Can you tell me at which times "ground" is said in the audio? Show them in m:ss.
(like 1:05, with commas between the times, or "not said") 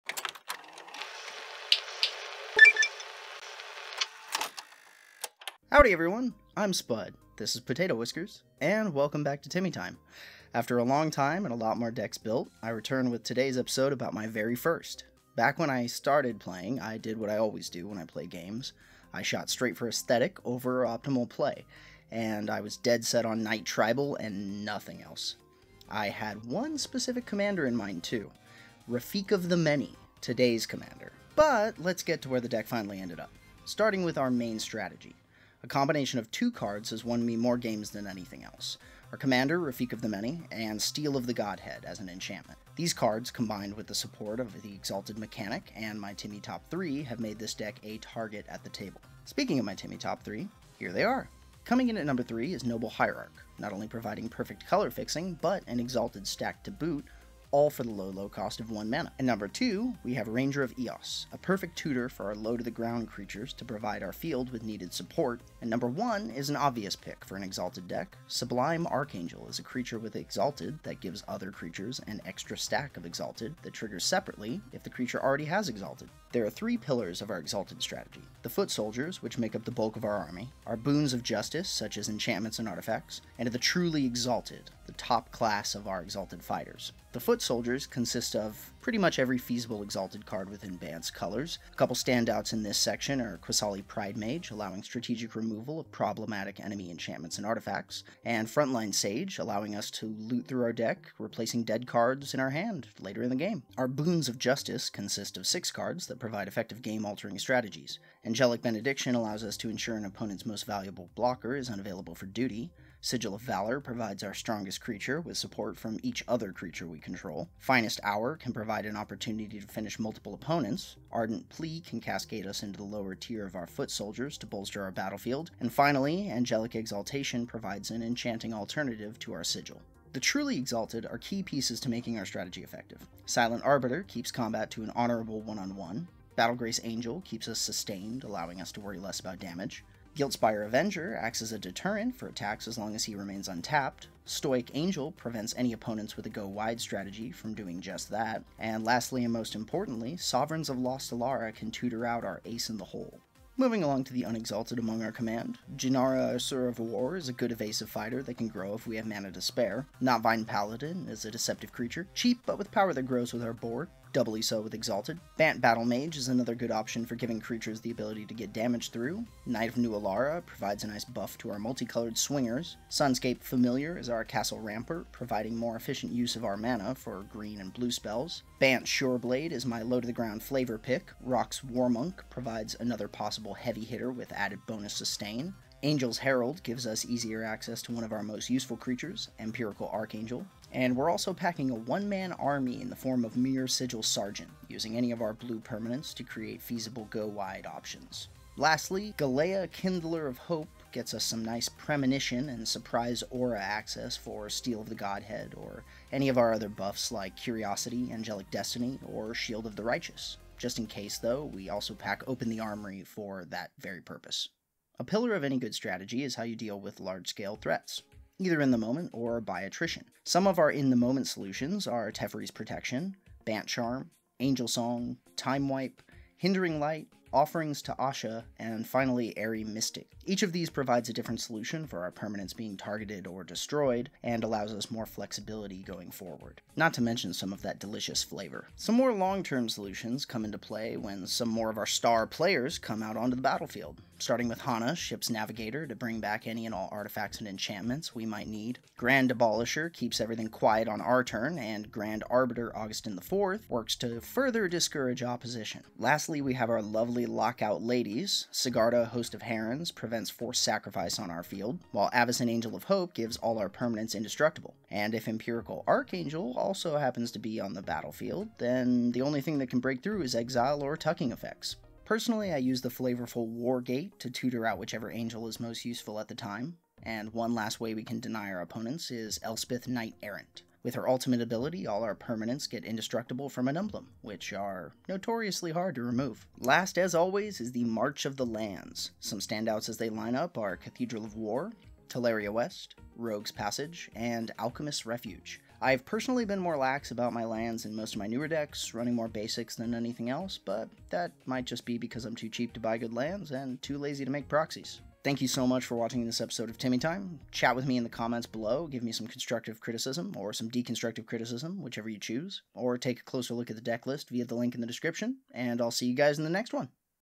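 1:02, 2:59.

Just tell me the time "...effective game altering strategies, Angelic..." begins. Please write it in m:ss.
1:46.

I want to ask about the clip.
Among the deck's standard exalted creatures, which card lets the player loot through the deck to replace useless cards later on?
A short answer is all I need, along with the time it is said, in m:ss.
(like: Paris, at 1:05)
Frontline Sage, at 1:38.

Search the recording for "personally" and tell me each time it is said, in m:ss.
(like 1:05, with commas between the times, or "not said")
4:32, 4:56.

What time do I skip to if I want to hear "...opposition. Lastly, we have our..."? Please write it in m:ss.
4:15.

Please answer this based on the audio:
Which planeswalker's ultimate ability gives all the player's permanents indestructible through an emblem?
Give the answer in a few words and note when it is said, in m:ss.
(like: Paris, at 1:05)
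Elspeth Knight Errant, at 4:39.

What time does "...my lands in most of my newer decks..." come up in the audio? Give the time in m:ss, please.
4:57.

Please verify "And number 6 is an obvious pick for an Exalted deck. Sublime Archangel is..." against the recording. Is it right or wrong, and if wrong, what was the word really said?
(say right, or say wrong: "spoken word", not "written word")
wrong: "1", not "6".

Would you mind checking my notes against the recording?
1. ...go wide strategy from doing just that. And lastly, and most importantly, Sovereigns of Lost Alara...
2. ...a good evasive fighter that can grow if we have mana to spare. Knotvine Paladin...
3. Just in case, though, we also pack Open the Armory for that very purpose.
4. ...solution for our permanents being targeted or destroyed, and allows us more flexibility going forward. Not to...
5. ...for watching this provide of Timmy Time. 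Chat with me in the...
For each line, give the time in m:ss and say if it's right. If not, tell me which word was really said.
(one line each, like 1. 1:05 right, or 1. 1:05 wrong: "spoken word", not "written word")
1. 2:26 right
2. 2:37 right
3. 3:30 right
4. 3:51 right
5. 5:05 wrong: "episode", not "provide".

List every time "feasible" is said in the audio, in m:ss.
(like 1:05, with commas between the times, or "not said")
1:29, 3:16.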